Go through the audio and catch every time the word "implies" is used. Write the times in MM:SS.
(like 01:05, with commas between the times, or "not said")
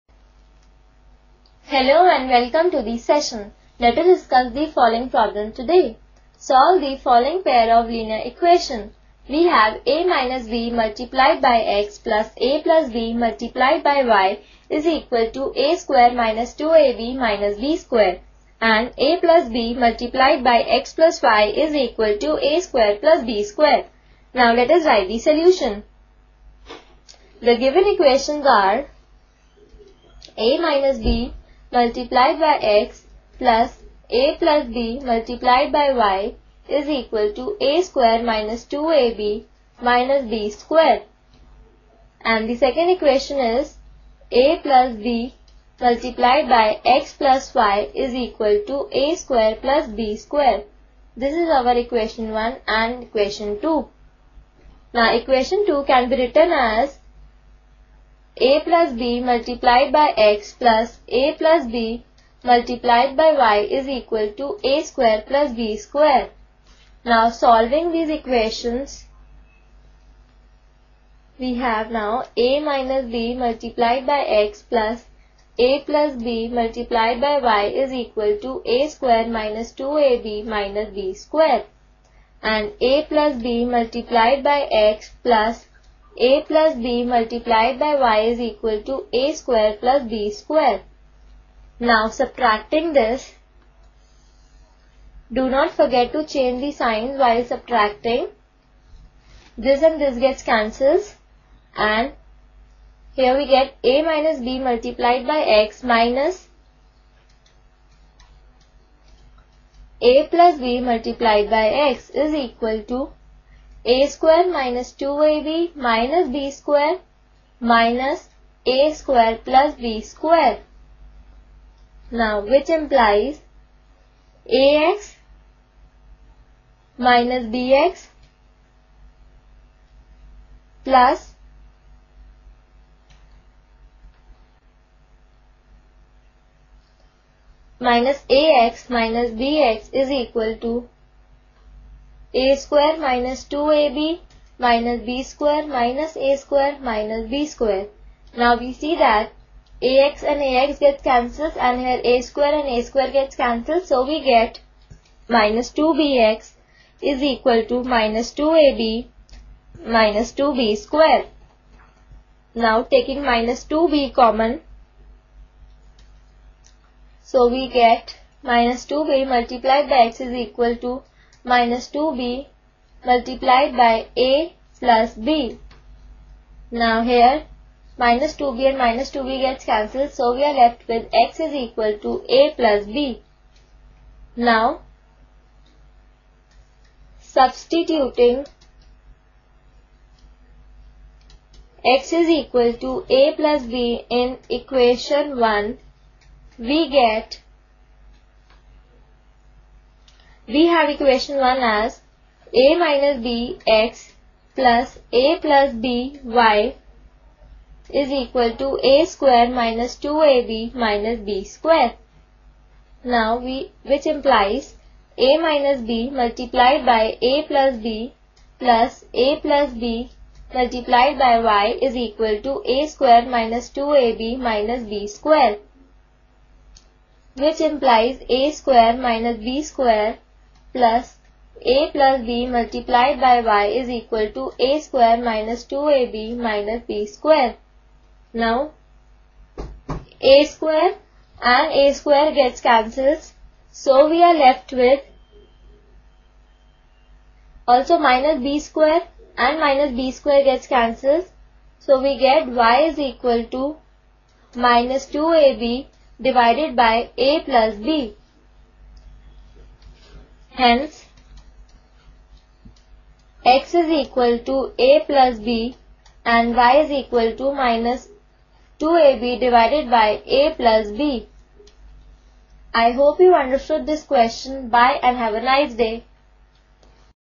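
02:02, 03:34, 03:47.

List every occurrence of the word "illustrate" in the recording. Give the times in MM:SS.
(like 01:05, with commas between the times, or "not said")
not said.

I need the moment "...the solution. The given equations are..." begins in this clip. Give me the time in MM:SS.
00:25.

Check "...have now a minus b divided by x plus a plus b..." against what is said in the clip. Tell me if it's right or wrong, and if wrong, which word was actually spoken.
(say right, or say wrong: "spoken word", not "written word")
wrong: "multiplied", not "divided".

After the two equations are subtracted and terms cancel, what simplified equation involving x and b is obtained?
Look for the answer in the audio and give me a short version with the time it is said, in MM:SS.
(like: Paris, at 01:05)
-2bx = -2ab - 2b², at 02:35.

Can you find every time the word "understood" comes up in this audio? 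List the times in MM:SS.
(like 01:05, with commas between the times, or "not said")
04:33.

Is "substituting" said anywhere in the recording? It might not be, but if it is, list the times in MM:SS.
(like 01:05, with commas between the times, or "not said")
03:07.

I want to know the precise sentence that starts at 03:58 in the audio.
Now, a square and a square gets cancelled.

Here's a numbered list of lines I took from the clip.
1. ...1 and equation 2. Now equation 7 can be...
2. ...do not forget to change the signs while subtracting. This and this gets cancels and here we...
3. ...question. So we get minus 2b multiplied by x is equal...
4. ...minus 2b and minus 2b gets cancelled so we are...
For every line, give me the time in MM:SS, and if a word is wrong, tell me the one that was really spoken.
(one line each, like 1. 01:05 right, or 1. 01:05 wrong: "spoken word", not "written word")
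1. 00:52 wrong: "2", not "7"
2. 01:35 right
3. 02:44 wrong: "common", not "question"
4. 02:57 right.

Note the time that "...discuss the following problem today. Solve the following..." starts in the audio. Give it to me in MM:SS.
00:04.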